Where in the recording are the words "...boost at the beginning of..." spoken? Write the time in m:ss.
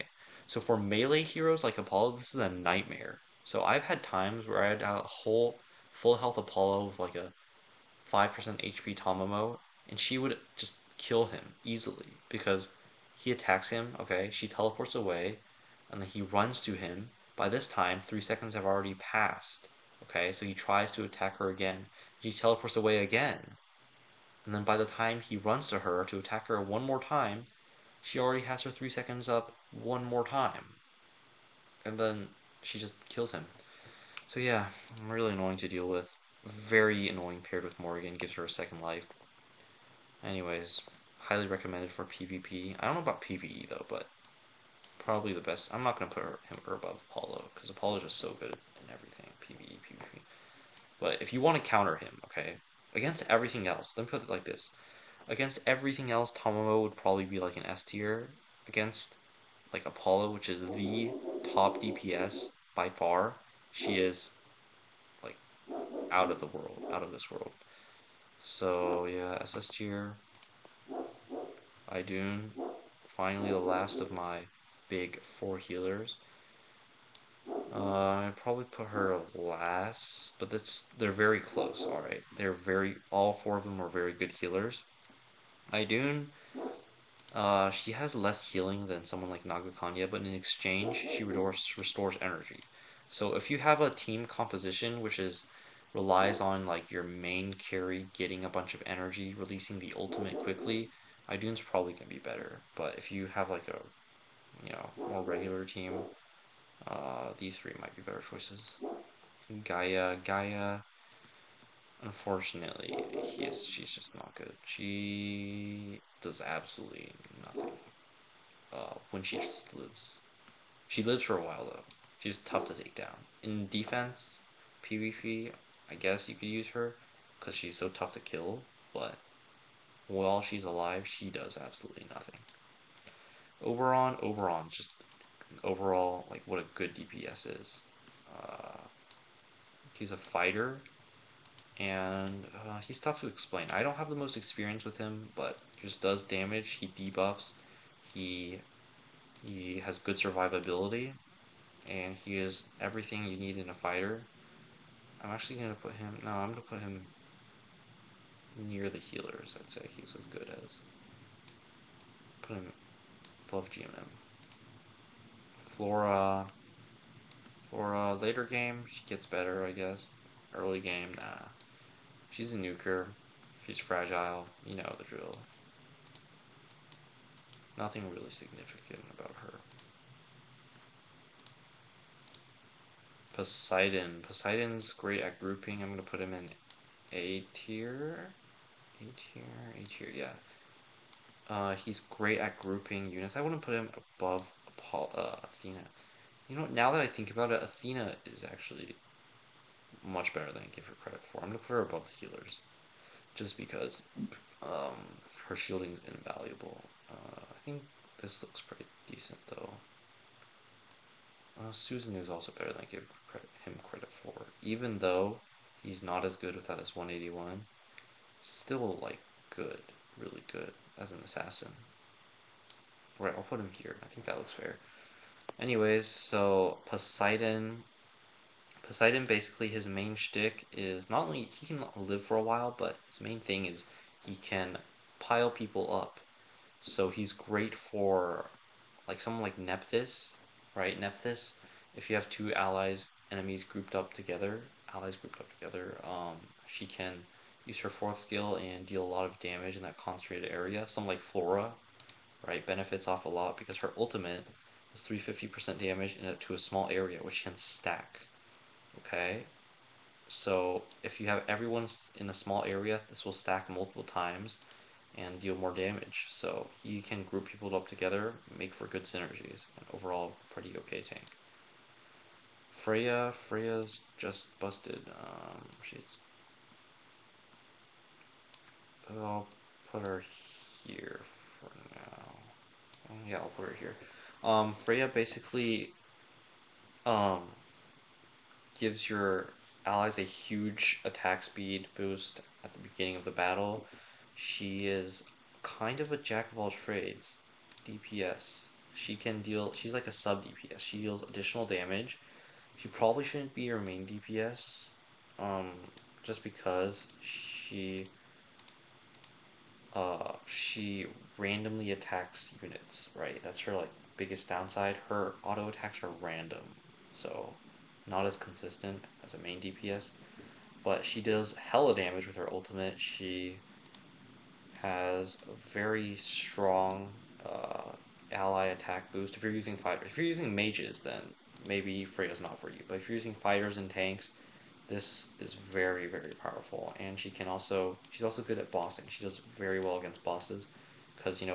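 4:51.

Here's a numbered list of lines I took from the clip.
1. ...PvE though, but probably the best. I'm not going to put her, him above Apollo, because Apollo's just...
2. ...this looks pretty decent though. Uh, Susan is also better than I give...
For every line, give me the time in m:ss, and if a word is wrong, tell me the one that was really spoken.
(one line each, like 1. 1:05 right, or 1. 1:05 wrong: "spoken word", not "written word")
1. 0:43 right
2. 3:28 right.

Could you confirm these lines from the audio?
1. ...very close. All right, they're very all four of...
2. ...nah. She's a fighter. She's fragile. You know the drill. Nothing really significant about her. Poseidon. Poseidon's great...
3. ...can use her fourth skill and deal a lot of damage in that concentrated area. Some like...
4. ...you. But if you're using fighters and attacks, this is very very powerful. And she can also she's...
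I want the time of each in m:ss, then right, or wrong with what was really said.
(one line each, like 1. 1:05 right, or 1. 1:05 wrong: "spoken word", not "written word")
1. 1:21 right
2. 2:51 wrong: "nuker", not "fighter"
3. 4:06 right
4. 5:32 wrong: "tanks", not "attacks".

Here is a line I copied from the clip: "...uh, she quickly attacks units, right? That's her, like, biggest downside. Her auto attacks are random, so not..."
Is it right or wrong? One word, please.
wrong.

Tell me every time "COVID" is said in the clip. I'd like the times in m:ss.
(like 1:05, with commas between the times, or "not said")
not said.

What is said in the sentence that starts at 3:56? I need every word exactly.
So he's great for like someone like Nephthys, right?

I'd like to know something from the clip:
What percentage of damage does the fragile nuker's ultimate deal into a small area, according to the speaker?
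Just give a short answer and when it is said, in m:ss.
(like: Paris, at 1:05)
350%, at 4:15.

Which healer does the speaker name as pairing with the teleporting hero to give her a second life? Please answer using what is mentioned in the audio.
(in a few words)
Morrigan.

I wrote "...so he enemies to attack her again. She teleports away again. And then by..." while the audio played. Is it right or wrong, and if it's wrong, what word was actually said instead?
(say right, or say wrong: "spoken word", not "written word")
wrong: "tries", not "enemies".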